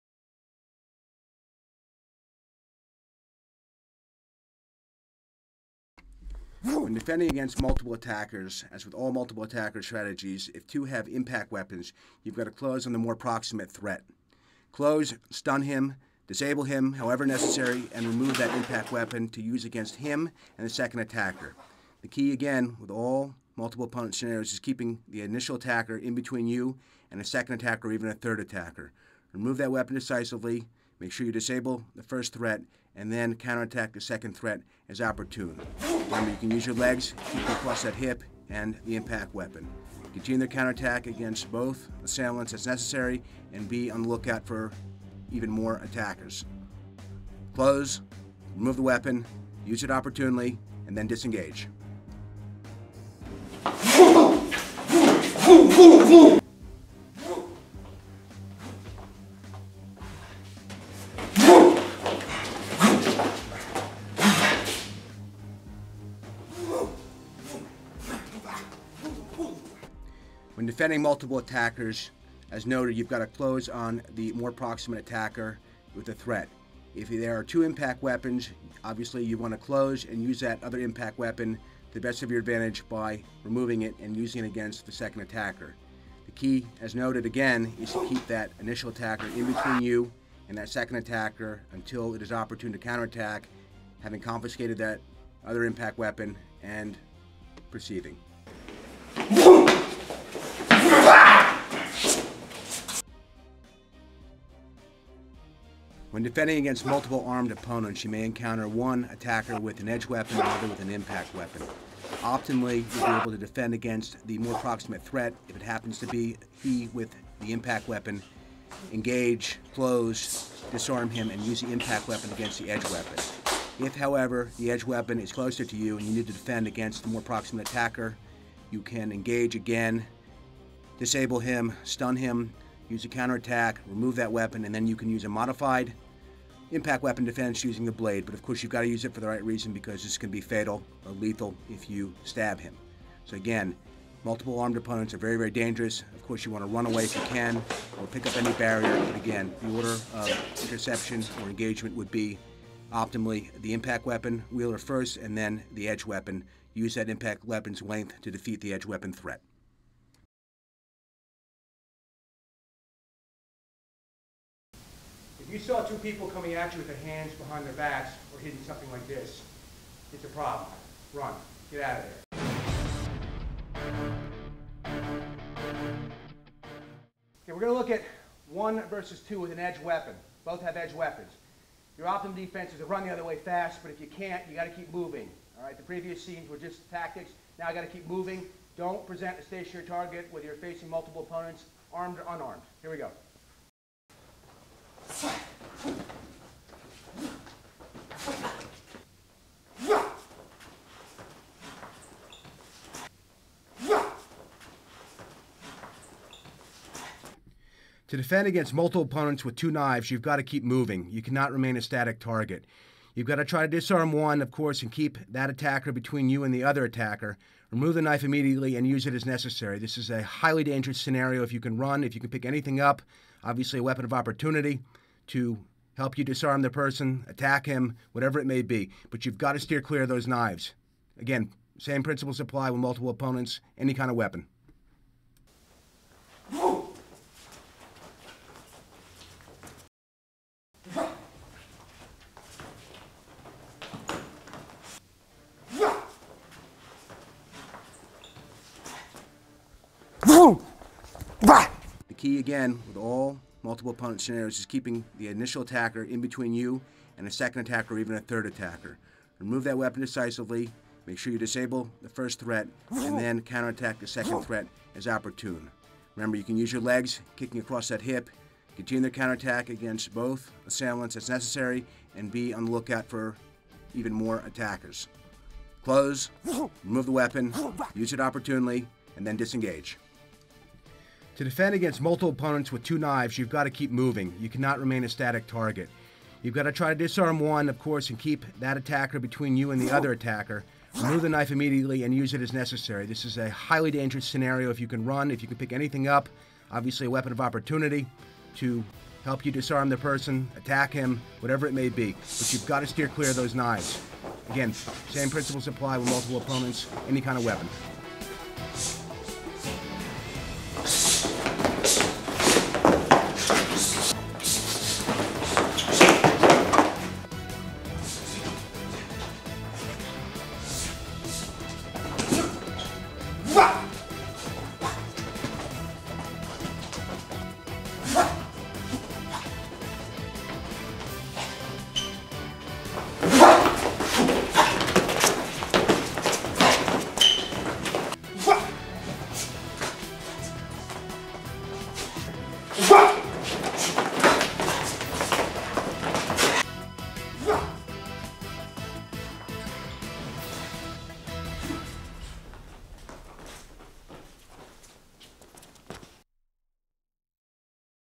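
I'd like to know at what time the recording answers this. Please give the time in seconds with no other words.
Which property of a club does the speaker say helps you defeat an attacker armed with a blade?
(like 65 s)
157 s.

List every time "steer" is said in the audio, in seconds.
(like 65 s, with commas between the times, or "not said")
229 s, 302 s.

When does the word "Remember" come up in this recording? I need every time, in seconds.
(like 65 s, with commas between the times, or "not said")
36 s, 266 s.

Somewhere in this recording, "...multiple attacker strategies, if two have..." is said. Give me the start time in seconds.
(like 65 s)
9 s.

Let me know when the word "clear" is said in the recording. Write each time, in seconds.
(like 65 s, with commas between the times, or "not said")
229 s, 303 s.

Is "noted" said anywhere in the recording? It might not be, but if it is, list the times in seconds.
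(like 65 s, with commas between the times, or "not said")
72 s, 86 s.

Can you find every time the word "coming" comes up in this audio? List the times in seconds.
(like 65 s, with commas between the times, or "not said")
166 s.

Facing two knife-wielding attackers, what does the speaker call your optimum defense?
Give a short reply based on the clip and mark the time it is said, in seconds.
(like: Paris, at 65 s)
run the other way fast, at 182 s.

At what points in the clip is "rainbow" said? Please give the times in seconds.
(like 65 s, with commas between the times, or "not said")
not said.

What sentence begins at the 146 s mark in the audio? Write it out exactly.
Of course, you want to run away if you can or pick up any barrier.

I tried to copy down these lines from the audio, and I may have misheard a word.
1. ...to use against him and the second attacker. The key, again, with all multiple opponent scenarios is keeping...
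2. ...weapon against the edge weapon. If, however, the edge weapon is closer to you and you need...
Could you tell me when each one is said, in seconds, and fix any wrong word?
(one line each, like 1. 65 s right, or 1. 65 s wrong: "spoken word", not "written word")
1. 19 s right
2. 122 s right.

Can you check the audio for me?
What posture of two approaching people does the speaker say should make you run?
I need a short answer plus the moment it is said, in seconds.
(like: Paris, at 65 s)
hands behind their backs, at 167 s.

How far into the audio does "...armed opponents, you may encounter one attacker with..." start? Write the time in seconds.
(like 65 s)
107 s.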